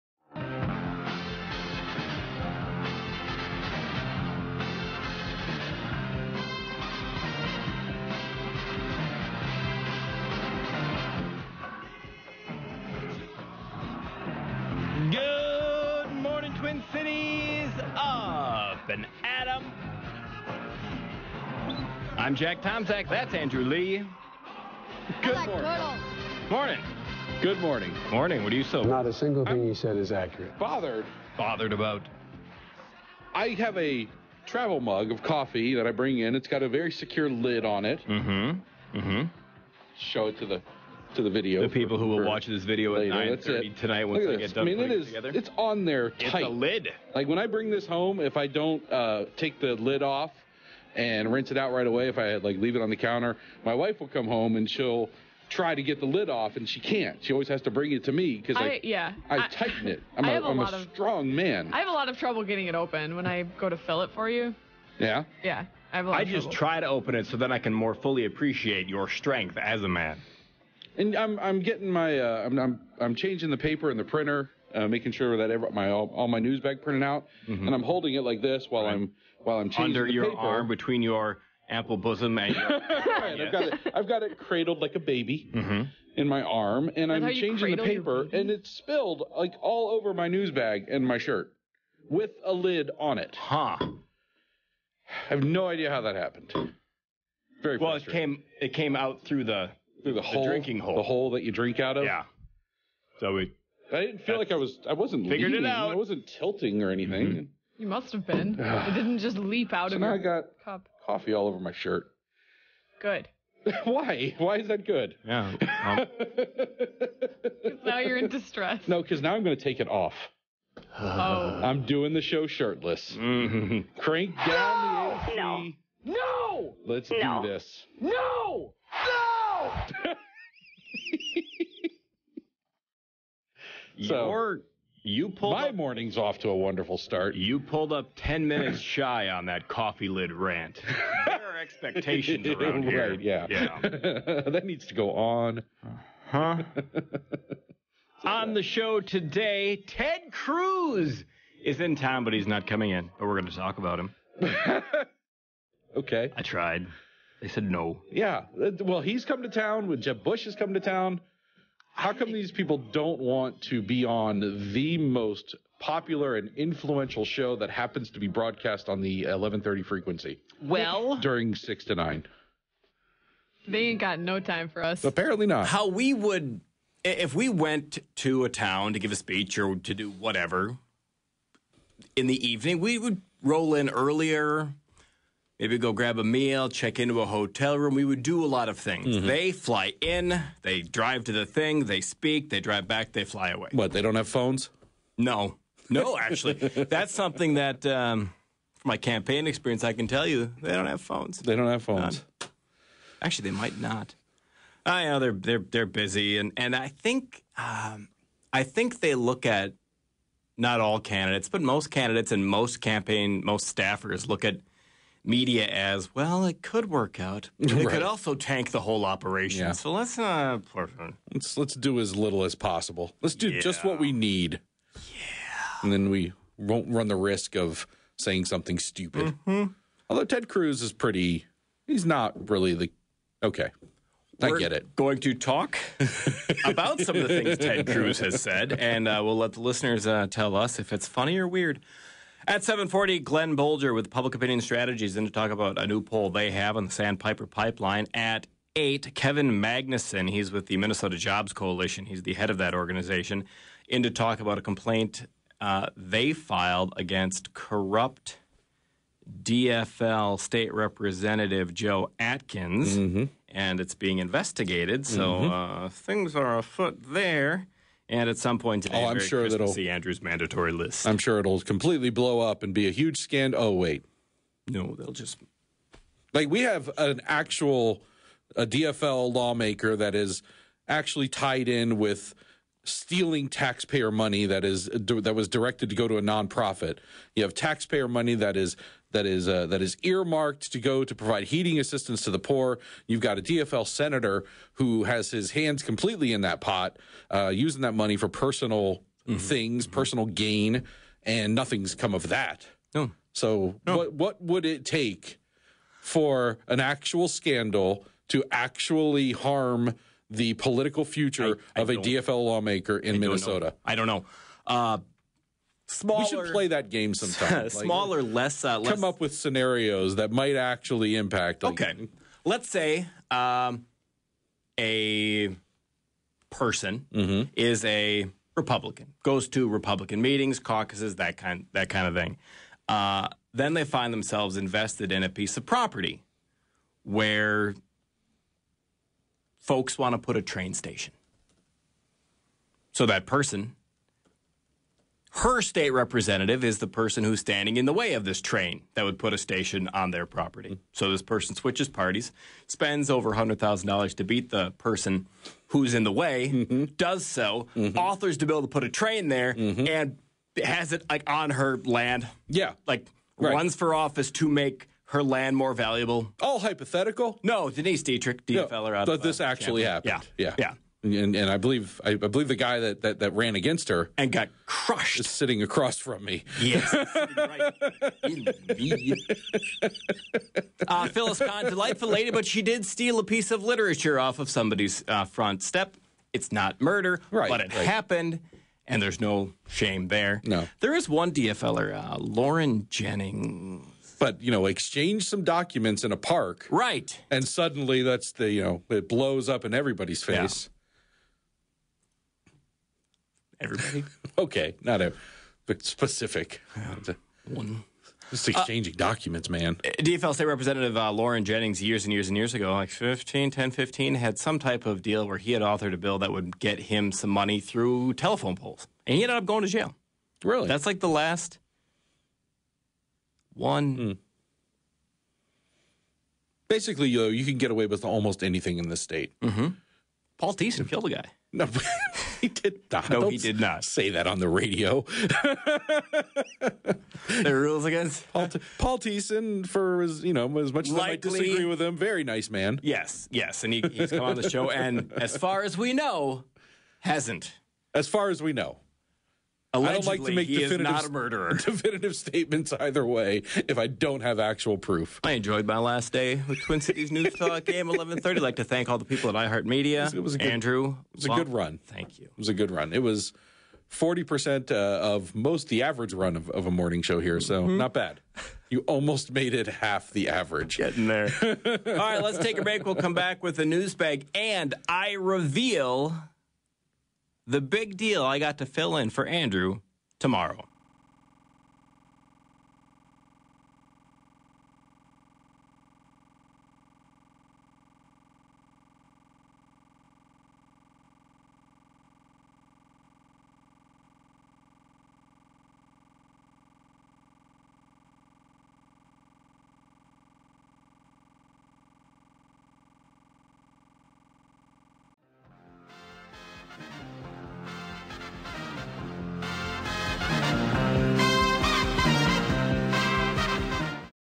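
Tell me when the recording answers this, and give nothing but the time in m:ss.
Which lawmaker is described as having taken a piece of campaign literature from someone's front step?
6:21.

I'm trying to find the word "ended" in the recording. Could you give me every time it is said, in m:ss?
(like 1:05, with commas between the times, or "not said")
6:59.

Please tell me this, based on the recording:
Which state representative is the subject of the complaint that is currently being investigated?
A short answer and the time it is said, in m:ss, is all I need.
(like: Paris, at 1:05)
Joe Atkins, at 4:21.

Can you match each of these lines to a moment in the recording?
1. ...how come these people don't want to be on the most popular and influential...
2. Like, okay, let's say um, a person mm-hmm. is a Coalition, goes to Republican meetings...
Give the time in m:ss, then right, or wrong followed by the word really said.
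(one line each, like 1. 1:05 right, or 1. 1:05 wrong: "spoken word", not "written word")
1. 2:41 right
2. 5:21 wrong: "Republican", not "Coalition".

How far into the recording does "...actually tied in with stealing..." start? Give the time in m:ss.
4:40.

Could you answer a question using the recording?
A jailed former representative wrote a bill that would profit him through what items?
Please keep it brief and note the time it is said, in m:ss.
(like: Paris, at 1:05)
Telephone poles, at 6:58.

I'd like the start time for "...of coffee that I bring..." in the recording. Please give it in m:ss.
0:35.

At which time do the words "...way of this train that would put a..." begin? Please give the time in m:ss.
5:47.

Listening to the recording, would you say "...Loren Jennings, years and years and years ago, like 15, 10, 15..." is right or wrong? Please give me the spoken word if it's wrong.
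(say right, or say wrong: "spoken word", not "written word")
right.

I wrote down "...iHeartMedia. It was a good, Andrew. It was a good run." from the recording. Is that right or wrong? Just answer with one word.
right.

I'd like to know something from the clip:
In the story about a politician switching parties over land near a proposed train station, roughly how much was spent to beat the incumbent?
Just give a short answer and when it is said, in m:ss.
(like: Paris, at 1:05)
Over $100,000, at 5:53.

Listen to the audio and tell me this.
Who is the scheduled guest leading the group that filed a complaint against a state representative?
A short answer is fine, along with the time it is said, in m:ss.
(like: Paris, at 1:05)
Kevin Magnuson, at 4:09.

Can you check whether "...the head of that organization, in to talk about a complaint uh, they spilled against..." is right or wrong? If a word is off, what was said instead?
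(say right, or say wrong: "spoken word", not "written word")
wrong: "filed", not "spilled".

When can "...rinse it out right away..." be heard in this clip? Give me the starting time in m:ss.
0:51.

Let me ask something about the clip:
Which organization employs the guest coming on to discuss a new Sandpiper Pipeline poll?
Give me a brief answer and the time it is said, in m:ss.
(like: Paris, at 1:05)
Public Opinion Strategies, at 4:04.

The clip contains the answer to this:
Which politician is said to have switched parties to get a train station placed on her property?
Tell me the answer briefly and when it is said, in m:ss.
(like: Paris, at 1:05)
Denise Dittrich, at 6:07.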